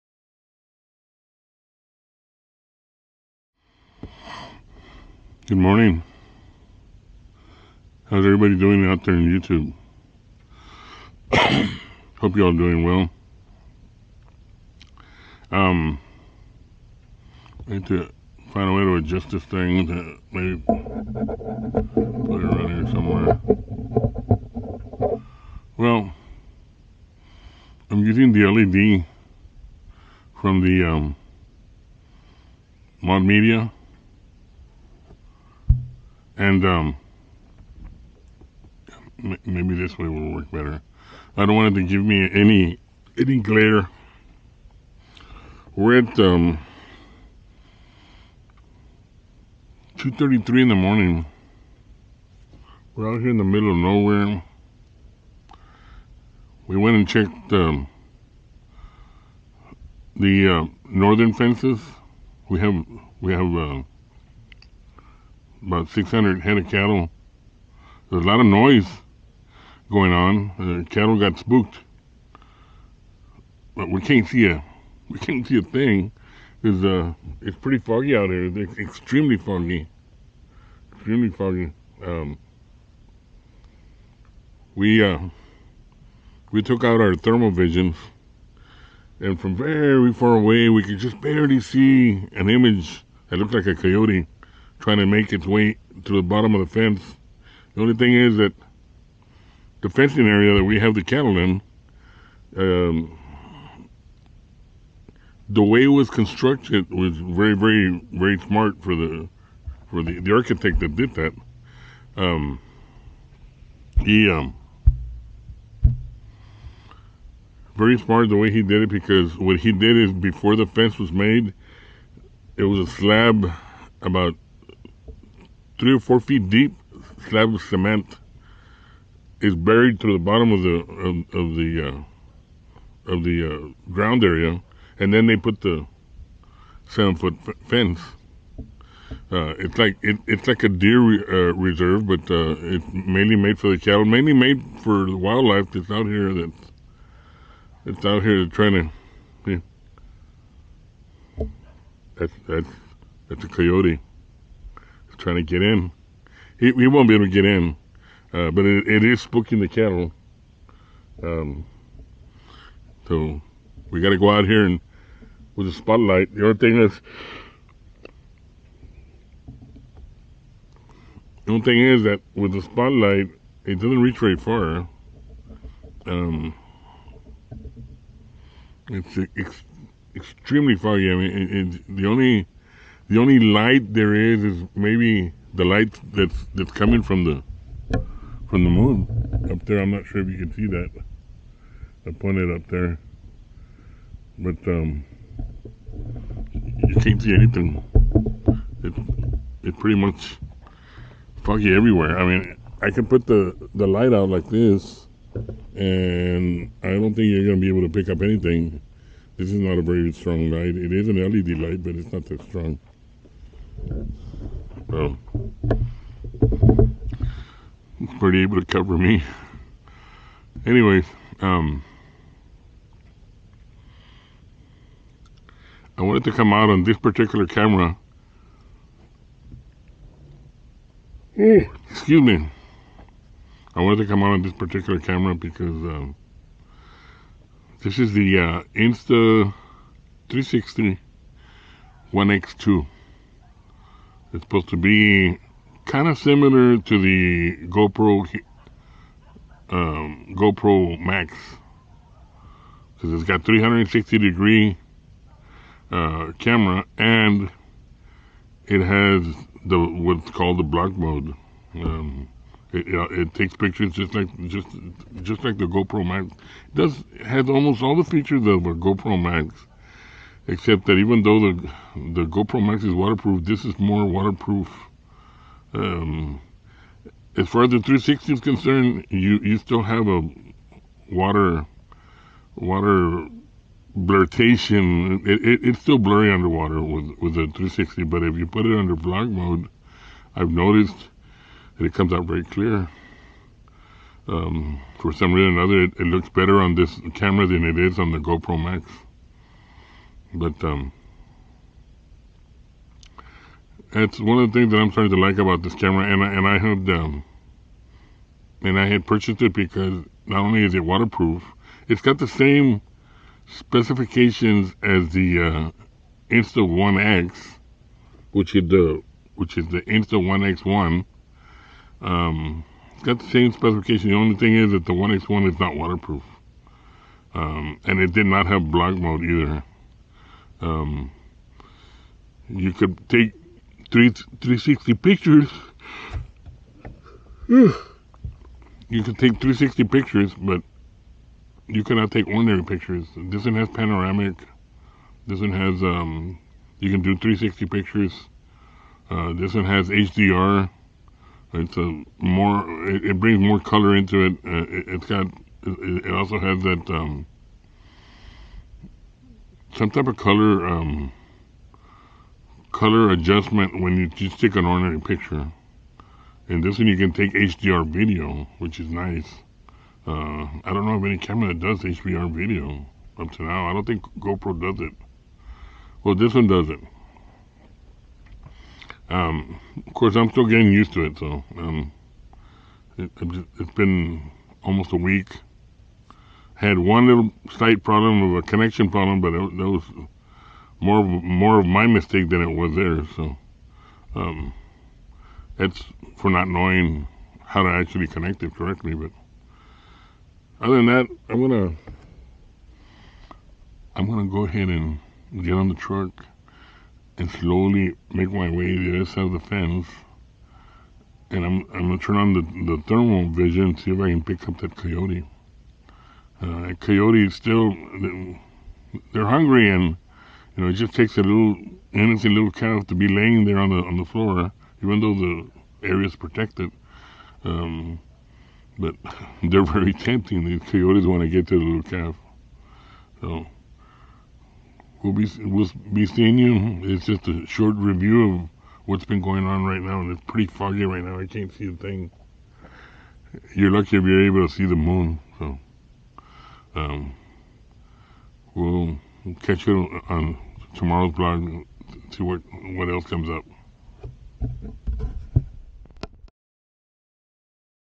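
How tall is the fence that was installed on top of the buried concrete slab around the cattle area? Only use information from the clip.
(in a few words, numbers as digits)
7 feet.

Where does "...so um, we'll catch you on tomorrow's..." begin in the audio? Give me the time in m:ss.
7:25.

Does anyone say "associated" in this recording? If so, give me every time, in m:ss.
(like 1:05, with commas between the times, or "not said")
not said.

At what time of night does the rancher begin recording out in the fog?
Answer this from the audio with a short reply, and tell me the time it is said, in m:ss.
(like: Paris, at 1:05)
2:33, at 0:49.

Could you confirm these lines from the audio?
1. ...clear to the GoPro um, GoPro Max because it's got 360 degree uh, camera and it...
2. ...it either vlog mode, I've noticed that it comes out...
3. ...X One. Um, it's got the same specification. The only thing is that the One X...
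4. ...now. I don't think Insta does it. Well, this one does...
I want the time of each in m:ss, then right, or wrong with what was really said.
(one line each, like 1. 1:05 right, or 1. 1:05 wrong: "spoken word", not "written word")
1. 4:06 wrong: "similar", not "clear"
2. 4:48 wrong: "under", not "either"
3. 5:20 right
4. 6:13 wrong: "GoPro", not "Insta".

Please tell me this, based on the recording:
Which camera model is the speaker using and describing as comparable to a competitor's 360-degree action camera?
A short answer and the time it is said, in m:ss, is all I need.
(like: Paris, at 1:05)
Insta360 One X2, at 3:58.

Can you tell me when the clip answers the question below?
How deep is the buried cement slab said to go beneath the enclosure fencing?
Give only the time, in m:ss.
2:05.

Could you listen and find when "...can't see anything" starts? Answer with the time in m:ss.
3:17.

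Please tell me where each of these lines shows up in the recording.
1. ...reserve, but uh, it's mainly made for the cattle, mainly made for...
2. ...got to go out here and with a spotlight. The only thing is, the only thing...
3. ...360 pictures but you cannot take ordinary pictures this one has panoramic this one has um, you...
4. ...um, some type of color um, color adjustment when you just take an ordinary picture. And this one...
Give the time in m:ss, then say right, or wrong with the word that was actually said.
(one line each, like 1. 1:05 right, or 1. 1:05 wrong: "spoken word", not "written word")
1. 2:21 right
2. 2:44 right
3. 5:39 right
4. 5:56 right.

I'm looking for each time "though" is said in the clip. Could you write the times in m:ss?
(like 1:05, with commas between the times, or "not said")
4:31, 7:04.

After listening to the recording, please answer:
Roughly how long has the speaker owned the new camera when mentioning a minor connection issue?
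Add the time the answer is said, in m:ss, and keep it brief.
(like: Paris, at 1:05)
almost a week, at 6:24.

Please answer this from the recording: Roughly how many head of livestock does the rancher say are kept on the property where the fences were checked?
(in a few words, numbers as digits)
600.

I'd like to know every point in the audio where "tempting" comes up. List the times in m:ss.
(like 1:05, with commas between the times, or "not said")
7:09.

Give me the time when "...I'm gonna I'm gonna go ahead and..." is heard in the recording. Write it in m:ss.
6:41.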